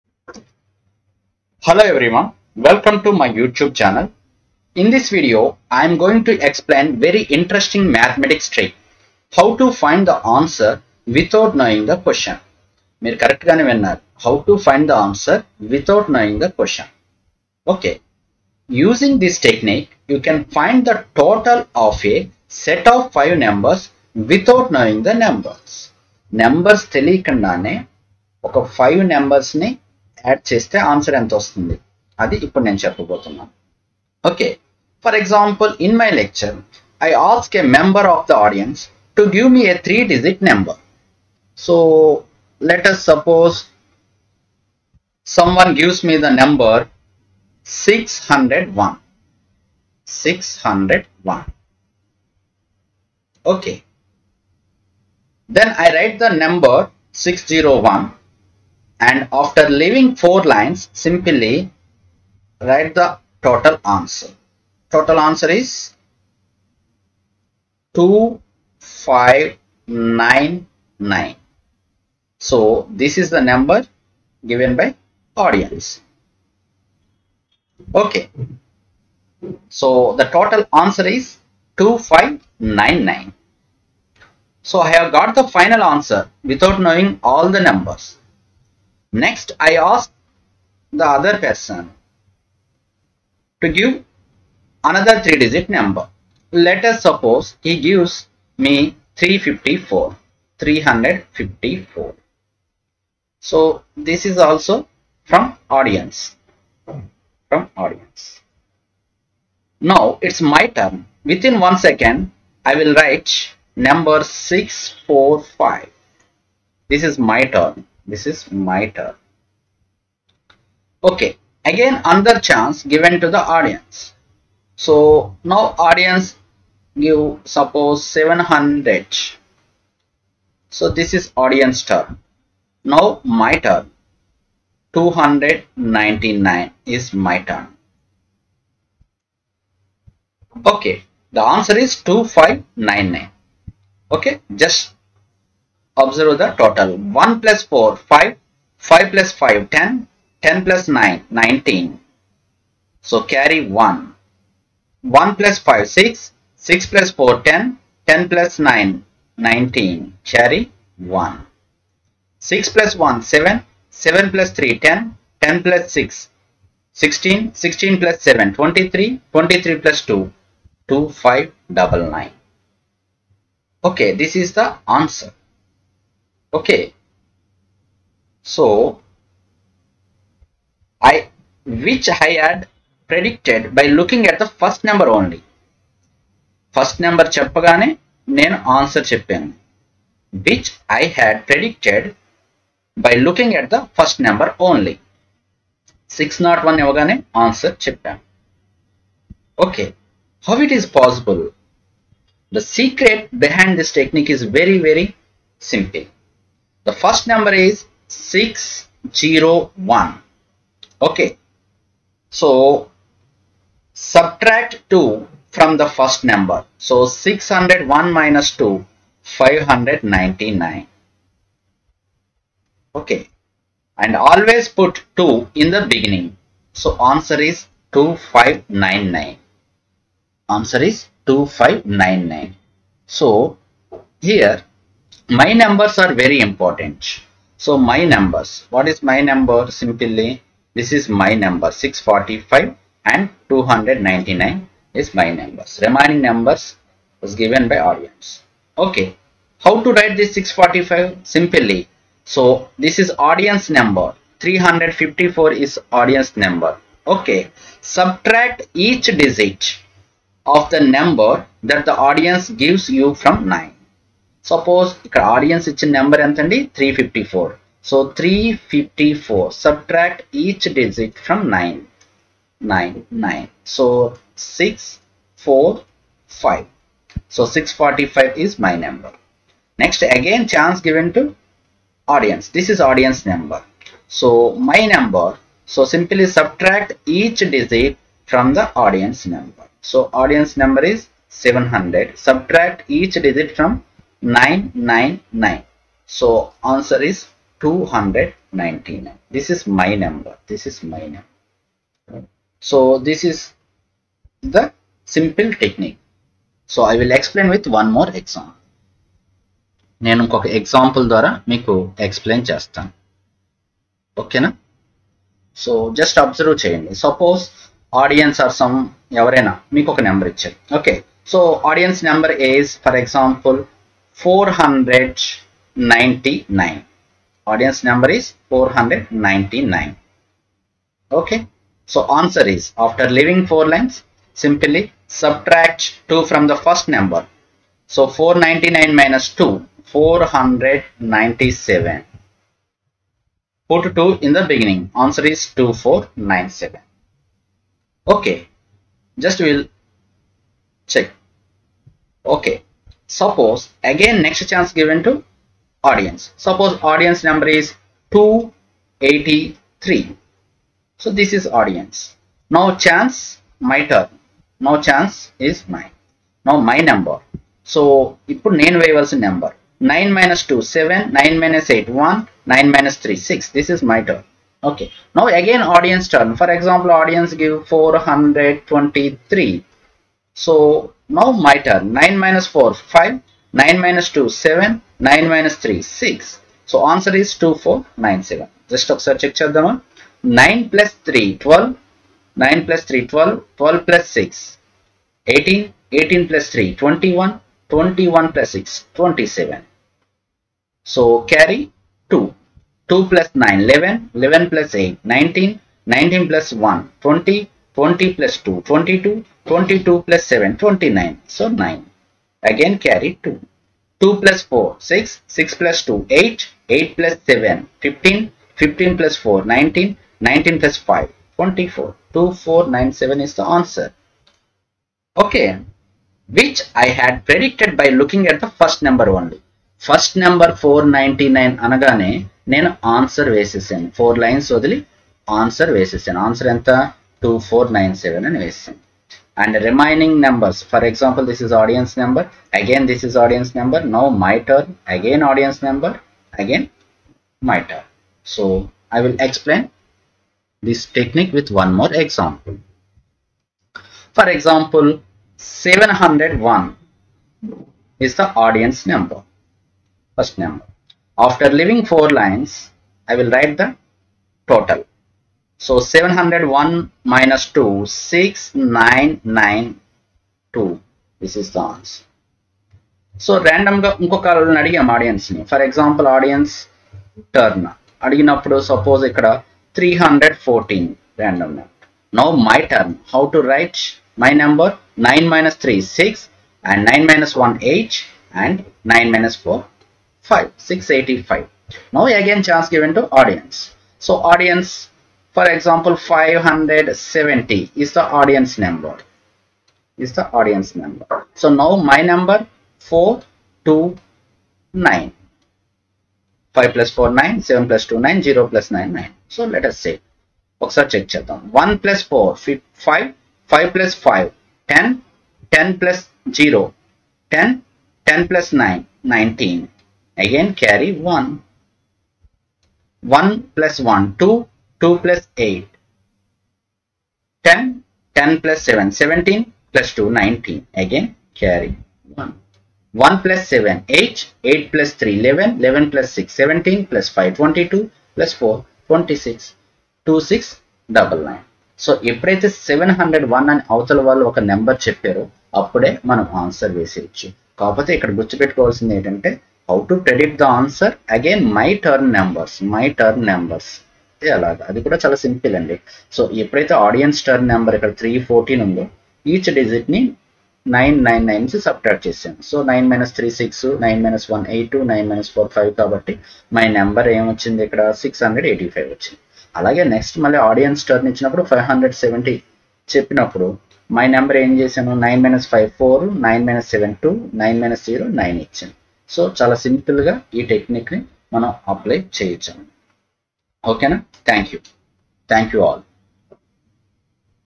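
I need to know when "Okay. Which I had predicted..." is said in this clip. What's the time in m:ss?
7:05.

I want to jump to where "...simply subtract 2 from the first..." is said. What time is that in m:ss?
5:34.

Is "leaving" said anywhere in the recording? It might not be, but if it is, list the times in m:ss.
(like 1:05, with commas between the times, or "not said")
0:59, 5:33, 7:41.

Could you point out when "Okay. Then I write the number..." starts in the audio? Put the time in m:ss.
0:53.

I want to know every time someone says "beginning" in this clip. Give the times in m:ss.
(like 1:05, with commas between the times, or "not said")
3:45, 5:44.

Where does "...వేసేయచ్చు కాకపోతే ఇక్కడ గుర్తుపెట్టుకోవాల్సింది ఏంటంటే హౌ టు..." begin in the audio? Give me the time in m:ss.
9:06.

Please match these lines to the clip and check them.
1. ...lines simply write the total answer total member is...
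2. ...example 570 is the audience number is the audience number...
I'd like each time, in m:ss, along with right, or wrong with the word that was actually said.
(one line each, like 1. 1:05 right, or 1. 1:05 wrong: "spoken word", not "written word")
1. 1:00 wrong: "answer", not "member"
2. 8:15 right.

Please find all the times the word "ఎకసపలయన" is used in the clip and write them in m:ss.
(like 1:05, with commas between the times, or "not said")
5:12.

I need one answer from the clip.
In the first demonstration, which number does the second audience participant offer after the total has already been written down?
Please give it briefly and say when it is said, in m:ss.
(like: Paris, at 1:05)
354, at 1:36.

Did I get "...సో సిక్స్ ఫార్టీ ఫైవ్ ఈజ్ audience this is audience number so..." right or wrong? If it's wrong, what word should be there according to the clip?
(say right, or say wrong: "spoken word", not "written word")
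right.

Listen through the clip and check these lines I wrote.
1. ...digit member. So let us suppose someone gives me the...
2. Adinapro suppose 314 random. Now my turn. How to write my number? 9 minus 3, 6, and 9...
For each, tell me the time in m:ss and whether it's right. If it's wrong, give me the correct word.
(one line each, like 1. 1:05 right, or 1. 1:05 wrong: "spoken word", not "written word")
1. 0:40 wrong: "number", not "member"
2. 7:58 right.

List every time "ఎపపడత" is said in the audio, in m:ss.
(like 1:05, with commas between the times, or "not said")
9:02, 9:16.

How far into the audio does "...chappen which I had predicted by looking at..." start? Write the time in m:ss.
3:09.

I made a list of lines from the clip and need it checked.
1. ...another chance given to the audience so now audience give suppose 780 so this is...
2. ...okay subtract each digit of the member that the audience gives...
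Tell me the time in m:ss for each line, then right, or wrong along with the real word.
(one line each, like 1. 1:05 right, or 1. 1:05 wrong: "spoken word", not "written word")
1. 2:02 wrong: "700", not "780"
2. 4:17 wrong: "number", not "member".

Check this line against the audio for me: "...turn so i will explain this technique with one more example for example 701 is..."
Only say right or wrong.
right.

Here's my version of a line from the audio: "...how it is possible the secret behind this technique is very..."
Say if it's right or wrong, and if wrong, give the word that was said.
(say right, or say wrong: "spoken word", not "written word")
right.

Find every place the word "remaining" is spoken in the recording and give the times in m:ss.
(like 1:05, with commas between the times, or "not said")
4:05, 7:19.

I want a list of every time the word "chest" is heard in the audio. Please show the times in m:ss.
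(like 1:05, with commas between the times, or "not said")
0:30.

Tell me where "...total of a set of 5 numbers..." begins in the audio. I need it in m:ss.
0:21.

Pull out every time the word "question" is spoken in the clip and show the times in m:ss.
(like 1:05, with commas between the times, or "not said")
0:11, 0:16.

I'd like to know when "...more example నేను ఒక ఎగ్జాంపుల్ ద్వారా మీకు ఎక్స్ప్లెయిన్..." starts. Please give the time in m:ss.
5:07.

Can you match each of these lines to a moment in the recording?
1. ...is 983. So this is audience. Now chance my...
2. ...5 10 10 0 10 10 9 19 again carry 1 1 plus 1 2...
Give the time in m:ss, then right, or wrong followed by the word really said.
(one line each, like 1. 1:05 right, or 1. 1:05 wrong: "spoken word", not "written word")
1. 5:57 wrong: "283", not "983"
2. 8:34 right.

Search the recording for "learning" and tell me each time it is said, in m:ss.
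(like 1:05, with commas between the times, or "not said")
not said.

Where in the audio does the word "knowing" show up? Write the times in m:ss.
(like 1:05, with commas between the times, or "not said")
0:11, 0:16, 0:24, 1:26.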